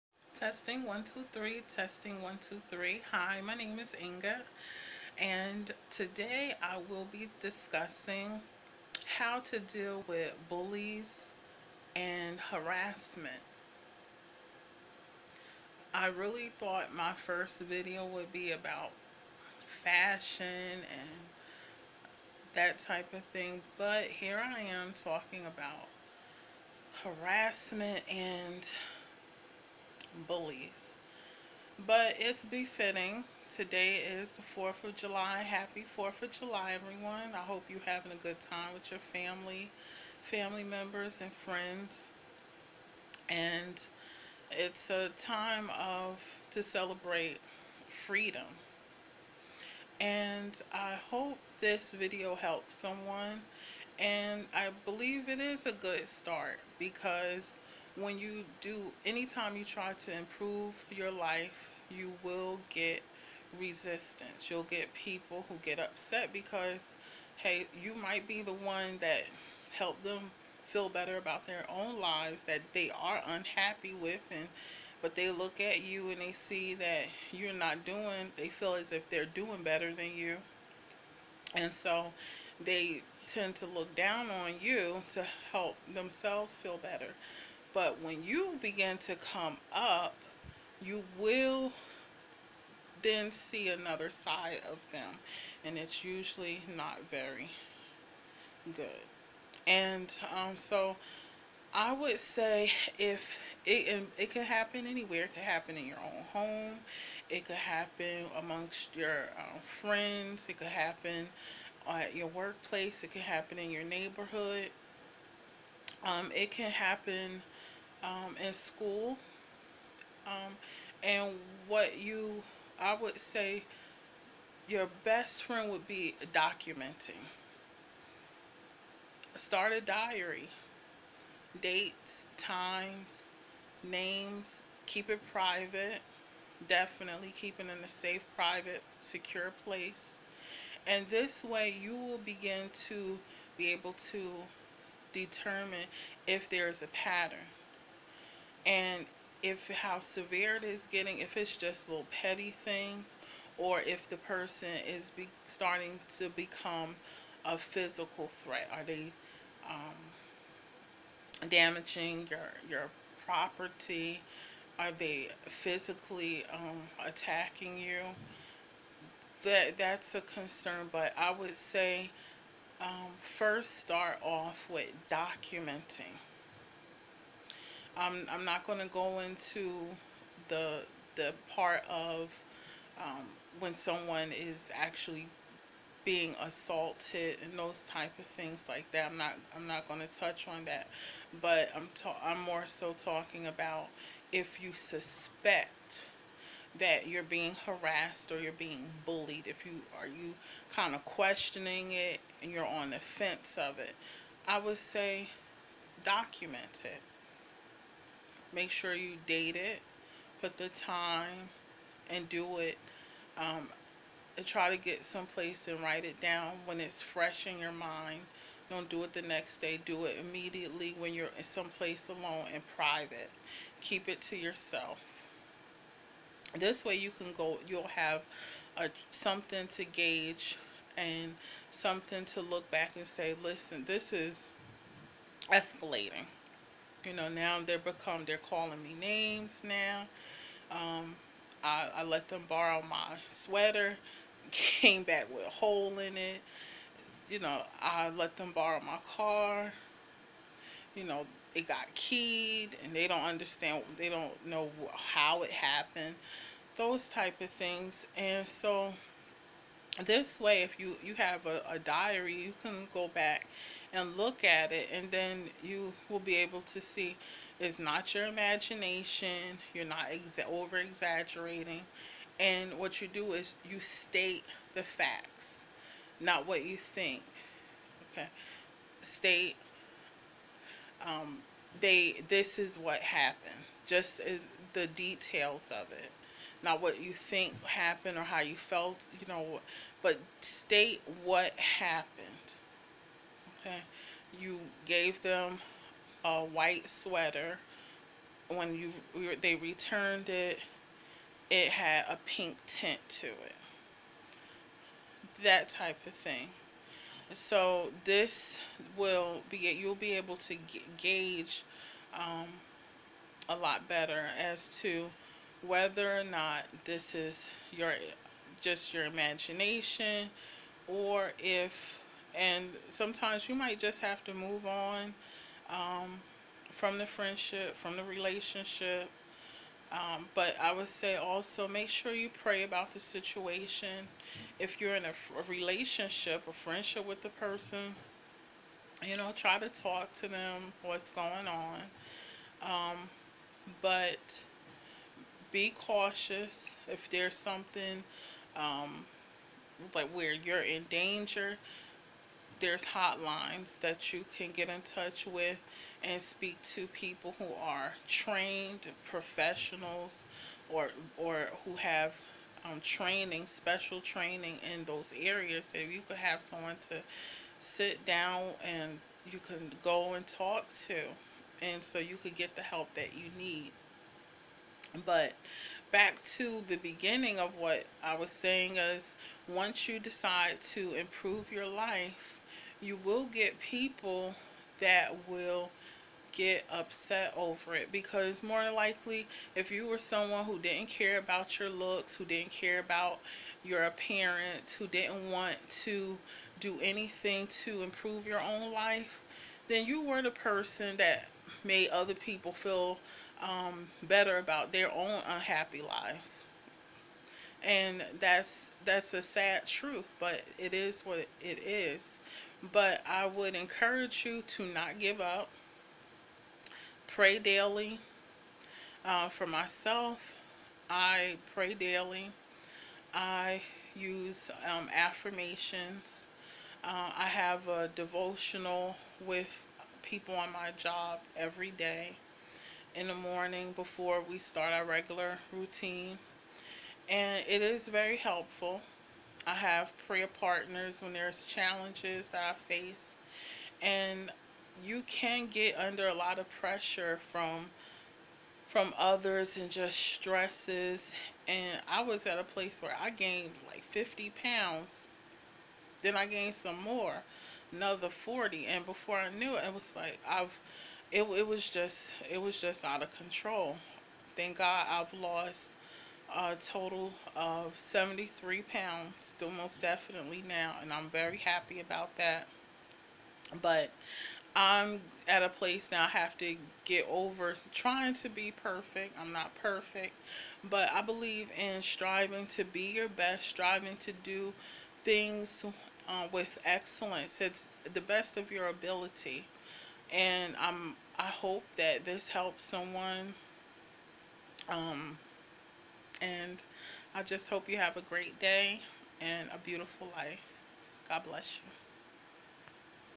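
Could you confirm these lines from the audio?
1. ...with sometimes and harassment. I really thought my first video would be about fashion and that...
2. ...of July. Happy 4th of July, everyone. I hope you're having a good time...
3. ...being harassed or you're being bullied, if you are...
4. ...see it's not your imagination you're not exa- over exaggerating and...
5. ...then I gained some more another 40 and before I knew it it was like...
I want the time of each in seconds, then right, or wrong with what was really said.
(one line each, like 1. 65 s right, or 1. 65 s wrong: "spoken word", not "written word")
1. 10 s wrong: "bullies", not "sometimes"
2. 34 s right
3. 197 s right
4. 266 s right
5. 456 s right.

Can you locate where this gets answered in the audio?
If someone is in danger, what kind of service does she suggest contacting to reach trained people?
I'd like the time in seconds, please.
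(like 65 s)
352 s.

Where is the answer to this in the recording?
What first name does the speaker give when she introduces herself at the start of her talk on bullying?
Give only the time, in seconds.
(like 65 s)
4 s.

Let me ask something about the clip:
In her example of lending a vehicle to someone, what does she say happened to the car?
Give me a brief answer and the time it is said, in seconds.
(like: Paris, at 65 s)
It got keyed, at 251 s.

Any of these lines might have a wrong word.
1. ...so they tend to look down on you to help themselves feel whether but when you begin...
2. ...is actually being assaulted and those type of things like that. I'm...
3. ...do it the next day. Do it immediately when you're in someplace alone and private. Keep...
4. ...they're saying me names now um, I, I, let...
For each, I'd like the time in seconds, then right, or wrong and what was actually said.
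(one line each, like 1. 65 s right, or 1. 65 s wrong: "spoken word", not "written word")
1. 81 s wrong: "better", not "whether"
2. 184 s right
3. 218 s right
4. 238 s wrong: "calling", not "saying".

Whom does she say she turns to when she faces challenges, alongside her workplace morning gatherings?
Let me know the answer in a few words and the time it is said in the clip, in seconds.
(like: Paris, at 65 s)
Prayer partners, at 440 s.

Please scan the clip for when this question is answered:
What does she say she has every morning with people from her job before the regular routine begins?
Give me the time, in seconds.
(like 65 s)
427 s.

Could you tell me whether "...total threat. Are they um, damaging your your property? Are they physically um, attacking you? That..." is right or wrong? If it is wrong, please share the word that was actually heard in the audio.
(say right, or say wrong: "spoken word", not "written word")
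wrong: "physical", not "total".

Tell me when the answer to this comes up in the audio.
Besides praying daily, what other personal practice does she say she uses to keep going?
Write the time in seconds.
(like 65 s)
424 s.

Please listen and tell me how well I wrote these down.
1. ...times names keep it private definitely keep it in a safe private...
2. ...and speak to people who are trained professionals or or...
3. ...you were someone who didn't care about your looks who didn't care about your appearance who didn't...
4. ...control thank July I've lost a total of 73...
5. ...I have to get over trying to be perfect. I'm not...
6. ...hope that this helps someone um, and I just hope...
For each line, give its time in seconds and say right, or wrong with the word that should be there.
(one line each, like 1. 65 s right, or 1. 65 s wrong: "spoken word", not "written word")
1. 132 s right
2. 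356 s right
3. 389 s right
4. 463 s wrong: "God", not "July"
5. 476 s right
6. 491 s right.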